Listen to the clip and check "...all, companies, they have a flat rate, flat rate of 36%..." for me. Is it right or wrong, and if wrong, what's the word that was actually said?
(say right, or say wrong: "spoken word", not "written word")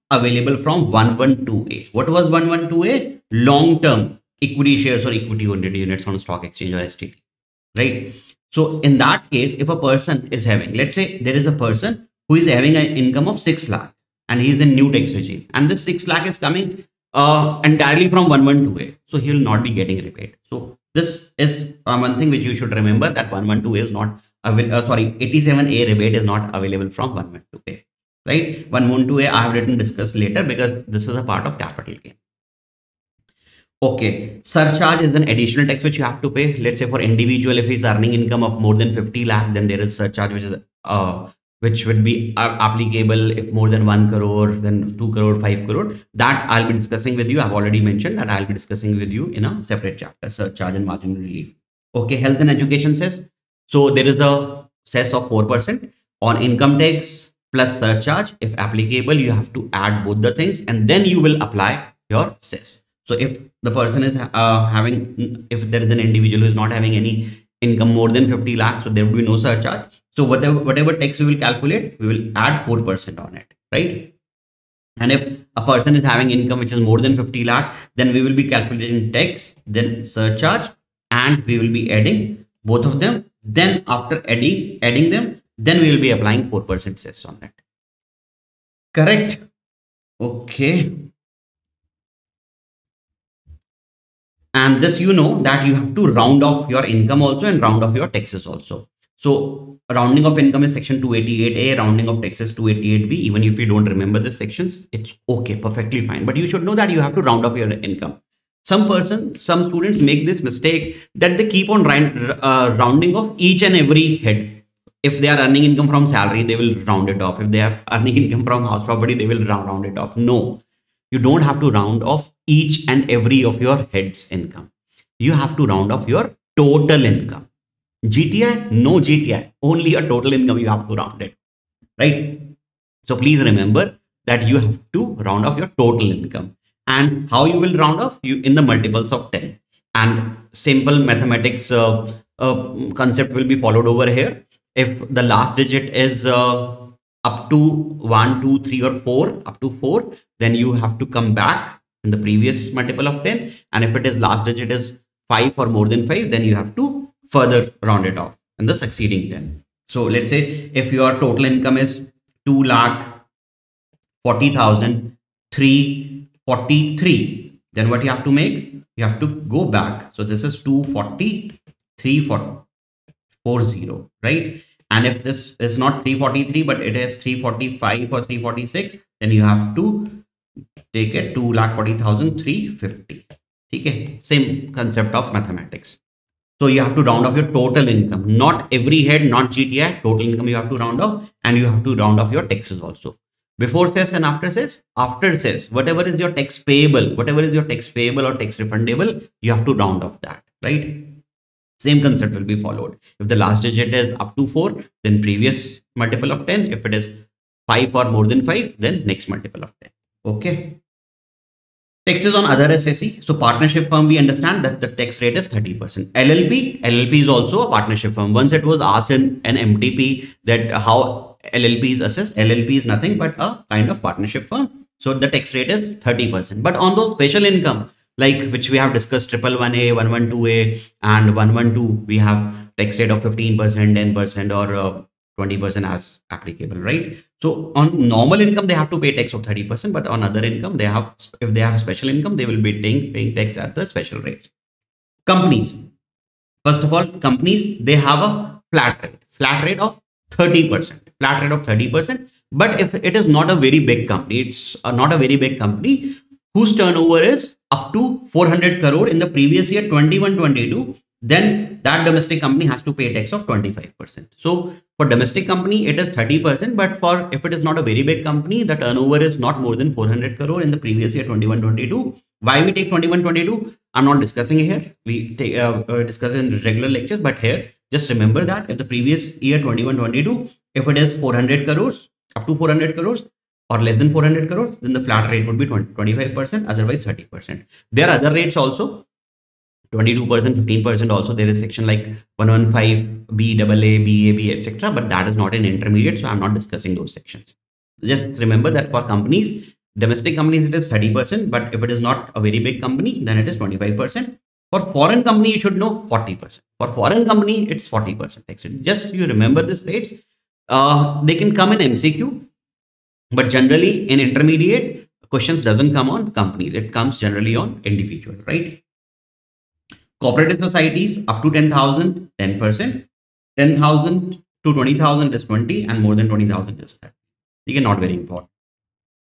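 wrong: "30", not "36".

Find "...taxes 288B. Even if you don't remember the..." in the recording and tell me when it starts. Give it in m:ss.
1:42.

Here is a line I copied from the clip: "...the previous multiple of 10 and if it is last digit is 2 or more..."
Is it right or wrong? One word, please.
wrong.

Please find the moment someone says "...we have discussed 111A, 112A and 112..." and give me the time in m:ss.
3:48.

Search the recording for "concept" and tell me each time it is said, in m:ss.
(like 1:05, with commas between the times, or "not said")
2:22, 3:04, 3:22.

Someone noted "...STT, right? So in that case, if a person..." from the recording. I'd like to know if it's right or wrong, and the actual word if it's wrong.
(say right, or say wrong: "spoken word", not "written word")
right.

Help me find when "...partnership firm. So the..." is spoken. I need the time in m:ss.
3:44.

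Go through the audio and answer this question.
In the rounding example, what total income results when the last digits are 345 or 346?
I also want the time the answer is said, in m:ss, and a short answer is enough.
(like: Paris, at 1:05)
2,40,350, at 3:01.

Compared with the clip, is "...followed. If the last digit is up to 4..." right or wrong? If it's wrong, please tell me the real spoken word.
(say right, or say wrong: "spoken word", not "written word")
right.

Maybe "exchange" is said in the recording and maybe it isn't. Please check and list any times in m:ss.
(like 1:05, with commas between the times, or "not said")
0:06.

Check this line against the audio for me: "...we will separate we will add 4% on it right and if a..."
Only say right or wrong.
wrong.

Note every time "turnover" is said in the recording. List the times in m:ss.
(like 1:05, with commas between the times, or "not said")
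4:16, 4:28.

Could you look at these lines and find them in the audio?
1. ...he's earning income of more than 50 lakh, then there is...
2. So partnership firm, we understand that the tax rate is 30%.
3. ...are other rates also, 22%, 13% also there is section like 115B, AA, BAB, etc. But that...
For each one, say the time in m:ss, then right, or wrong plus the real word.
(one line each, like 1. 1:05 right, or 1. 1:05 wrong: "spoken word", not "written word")
1. 0:37 right
2. 3:33 right
3. 4:48 wrong: "15", not "13".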